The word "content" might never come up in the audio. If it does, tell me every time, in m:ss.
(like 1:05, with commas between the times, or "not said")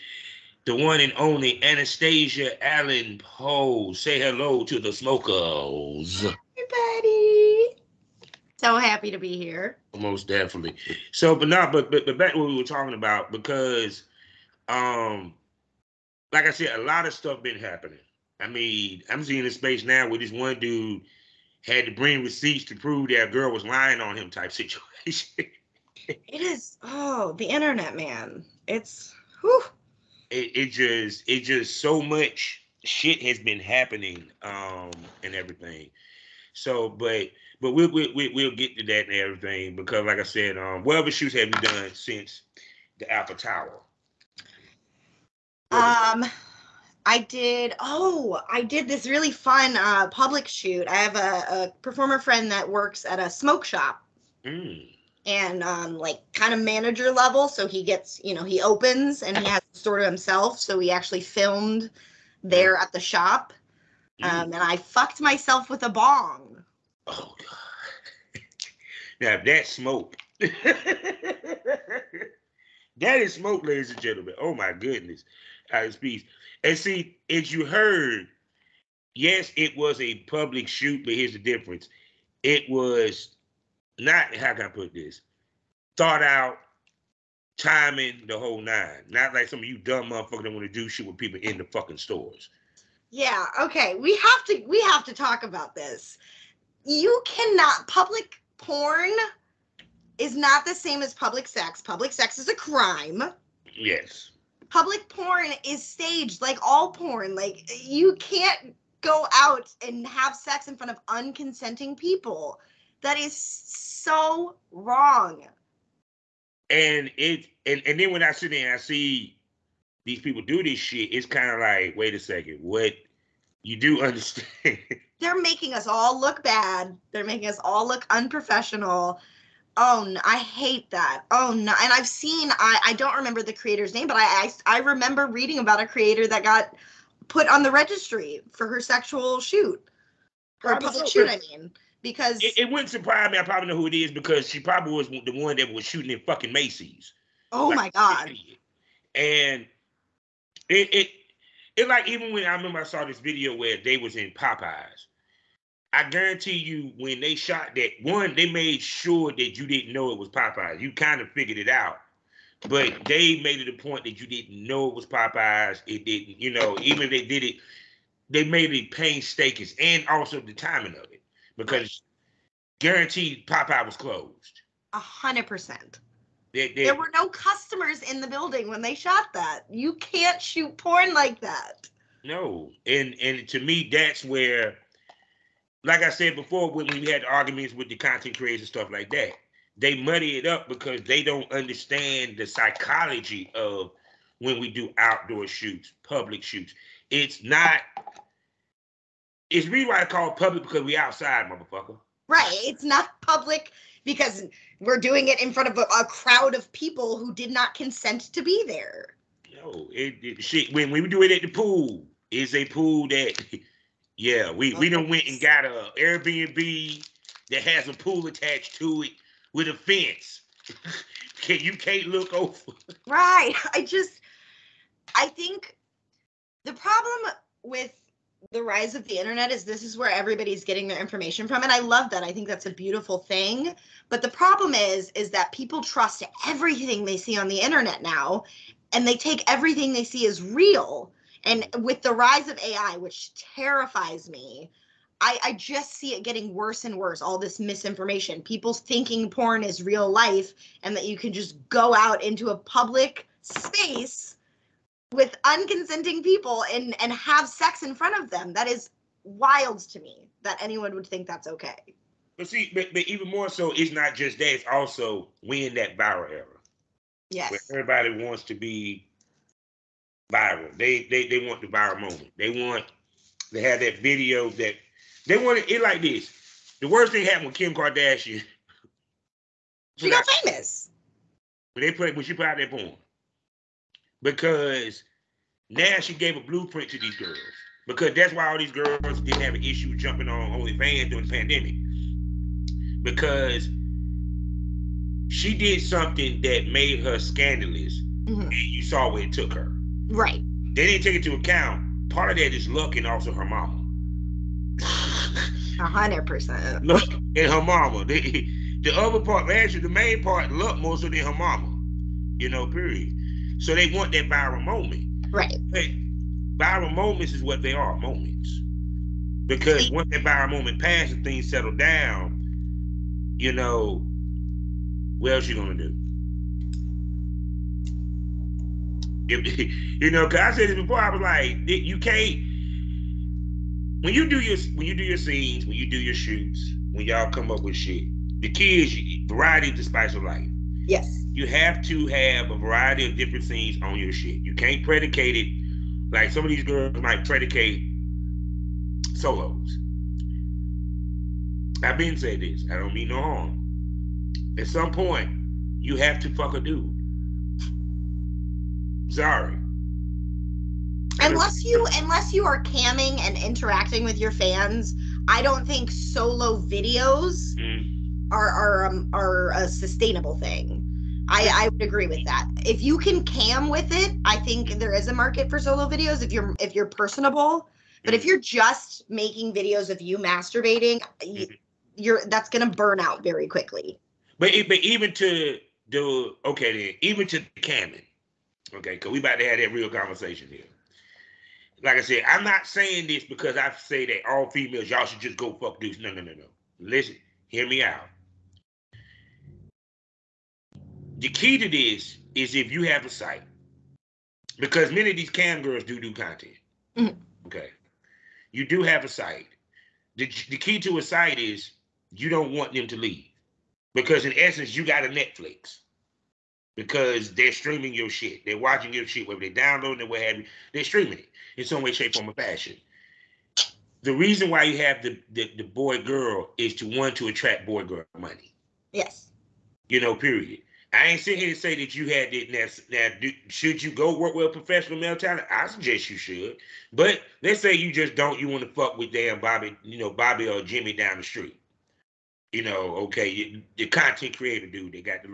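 3:07, 6:46, 7:23.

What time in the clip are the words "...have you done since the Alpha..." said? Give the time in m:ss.
0:41.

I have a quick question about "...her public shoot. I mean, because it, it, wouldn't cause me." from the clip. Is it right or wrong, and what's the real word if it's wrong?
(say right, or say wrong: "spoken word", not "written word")
wrong: "surprise", not "cause".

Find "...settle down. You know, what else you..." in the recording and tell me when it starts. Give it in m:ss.
5:21.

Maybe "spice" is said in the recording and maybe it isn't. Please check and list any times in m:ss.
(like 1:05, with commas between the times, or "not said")
5:39.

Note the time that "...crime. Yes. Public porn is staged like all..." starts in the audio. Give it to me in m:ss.
1:42.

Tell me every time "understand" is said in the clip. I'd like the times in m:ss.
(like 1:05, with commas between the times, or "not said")
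2:04, 3:11.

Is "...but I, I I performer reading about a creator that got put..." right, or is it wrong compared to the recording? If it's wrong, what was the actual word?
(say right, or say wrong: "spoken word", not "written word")
wrong: "remember", not "performer".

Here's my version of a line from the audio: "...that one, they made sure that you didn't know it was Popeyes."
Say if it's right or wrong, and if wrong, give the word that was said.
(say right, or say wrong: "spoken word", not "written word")
right.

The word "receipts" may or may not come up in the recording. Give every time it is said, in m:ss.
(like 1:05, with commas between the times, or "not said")
0:22.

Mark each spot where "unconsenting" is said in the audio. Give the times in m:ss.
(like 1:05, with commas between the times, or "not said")
1:51, 4:15.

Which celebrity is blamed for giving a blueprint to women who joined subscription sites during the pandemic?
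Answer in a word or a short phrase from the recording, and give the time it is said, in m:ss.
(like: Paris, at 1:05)
Kim Kardashian, at 4:37.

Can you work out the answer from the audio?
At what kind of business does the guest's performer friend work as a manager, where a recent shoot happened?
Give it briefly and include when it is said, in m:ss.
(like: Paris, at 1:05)
Smoke shop, at 0:53.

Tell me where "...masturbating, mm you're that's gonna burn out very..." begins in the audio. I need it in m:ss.
6:20.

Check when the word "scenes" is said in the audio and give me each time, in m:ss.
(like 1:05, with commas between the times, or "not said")
5:35, 5:43.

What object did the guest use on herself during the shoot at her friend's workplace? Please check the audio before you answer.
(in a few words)
A bong.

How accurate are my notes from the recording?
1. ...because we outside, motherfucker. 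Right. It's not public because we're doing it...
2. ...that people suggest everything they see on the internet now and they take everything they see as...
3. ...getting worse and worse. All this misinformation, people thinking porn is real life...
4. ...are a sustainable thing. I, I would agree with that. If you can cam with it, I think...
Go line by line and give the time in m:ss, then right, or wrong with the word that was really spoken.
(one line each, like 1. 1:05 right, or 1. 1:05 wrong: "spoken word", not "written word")
1. 3:20 right
2. 3:55 wrong: "trust", not "suggest"
3. 4:06 right
4. 6:09 right.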